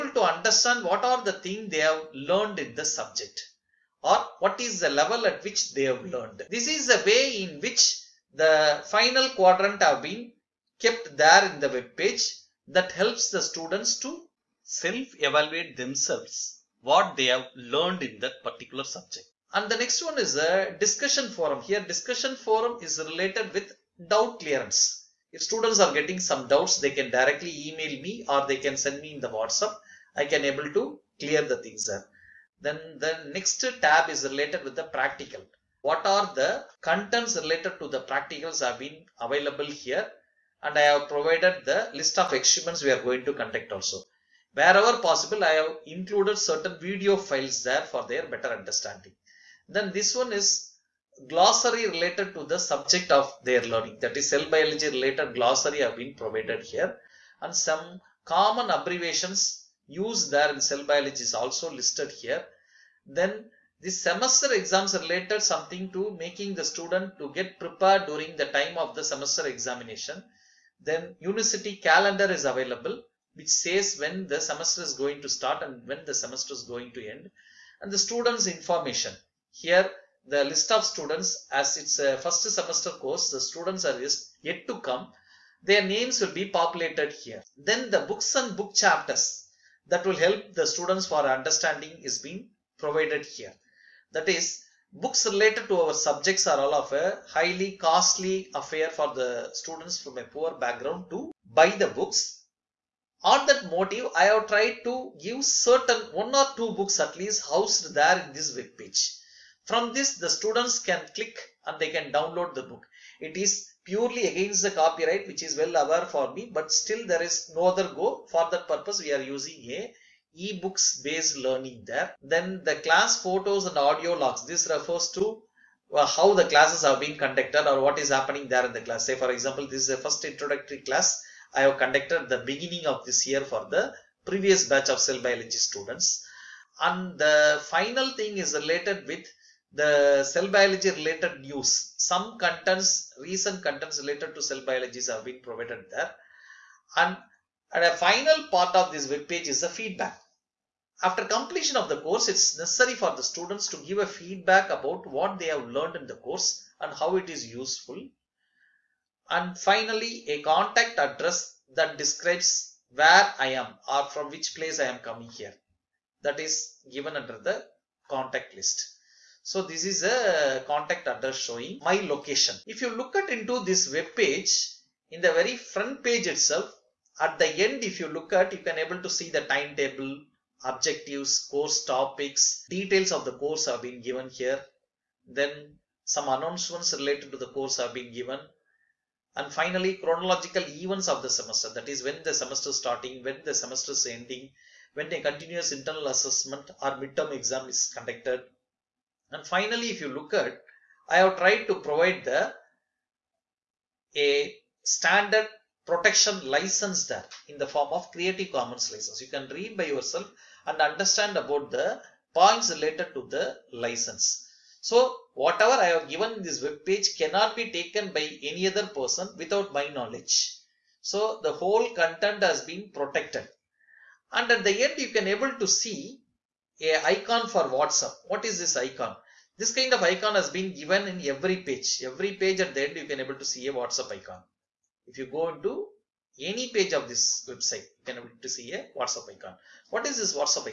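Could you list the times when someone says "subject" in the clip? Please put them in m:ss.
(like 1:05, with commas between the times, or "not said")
0:02, 0:18, 0:52, 1:35.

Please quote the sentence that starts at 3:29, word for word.
You can read by yourself and understand about the points related to the license.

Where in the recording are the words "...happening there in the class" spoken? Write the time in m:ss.
2:08.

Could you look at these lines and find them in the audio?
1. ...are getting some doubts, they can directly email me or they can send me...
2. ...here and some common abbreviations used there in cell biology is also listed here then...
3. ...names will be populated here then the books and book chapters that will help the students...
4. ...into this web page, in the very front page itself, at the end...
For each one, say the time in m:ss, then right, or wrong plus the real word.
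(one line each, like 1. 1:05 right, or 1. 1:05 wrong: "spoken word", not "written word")
1. 0:25 right
2. 0:56 right
3. 1:25 right
4. 2:53 right.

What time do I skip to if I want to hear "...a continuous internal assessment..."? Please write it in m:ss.
3:15.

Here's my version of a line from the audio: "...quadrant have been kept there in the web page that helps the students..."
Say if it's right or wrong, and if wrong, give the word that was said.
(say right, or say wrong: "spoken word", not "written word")
right.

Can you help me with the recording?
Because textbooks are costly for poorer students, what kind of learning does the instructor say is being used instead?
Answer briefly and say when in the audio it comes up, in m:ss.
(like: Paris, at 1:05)
ebooks based learning, at 2:00.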